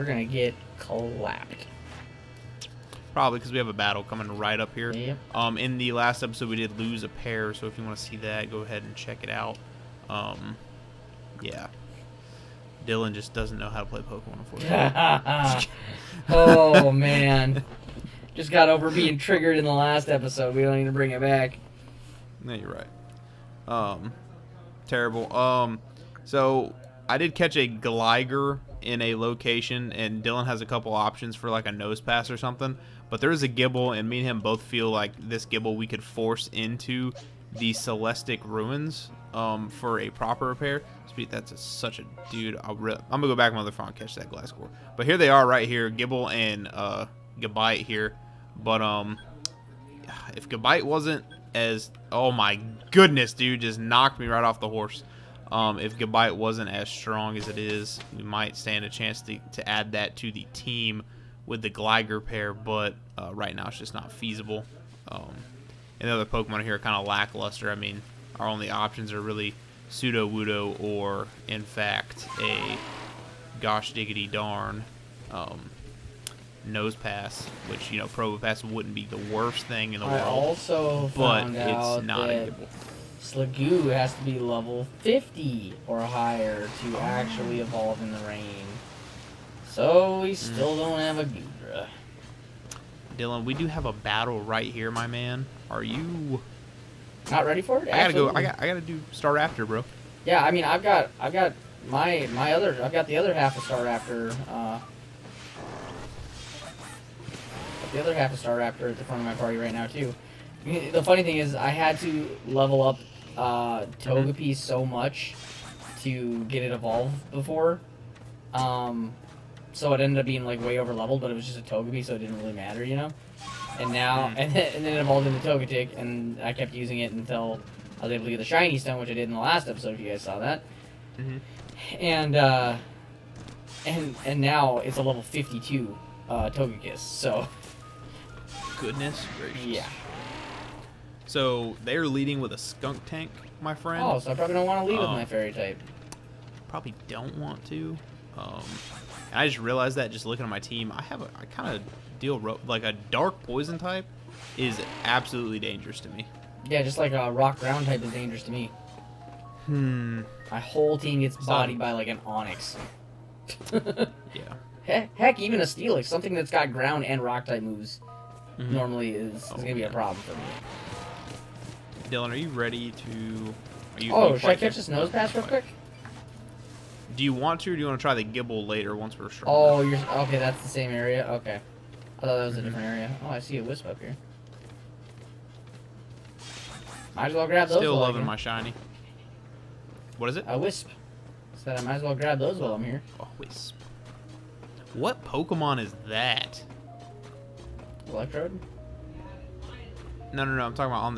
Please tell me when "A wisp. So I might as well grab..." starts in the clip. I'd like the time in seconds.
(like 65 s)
190 s.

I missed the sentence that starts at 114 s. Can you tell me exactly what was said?
so much to get it evolved before.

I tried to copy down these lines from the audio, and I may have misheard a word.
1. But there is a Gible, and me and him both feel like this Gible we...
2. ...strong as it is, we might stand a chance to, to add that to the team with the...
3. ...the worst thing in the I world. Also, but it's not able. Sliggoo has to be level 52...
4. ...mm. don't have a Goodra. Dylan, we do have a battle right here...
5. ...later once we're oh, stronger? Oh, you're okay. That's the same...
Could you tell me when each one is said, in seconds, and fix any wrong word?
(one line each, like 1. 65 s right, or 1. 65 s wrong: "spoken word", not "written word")
1. 33 s right
2. 56 s right
3. 79 s wrong: "50", not "52"
4. 90 s right
5. 178 s right.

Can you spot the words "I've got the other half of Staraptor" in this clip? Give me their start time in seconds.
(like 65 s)
102 s.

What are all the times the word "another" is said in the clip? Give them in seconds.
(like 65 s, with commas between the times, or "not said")
43 s.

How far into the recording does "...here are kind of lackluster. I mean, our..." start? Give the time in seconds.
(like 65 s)
66 s.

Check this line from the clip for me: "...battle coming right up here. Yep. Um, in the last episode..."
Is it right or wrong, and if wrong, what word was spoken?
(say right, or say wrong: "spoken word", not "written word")
right.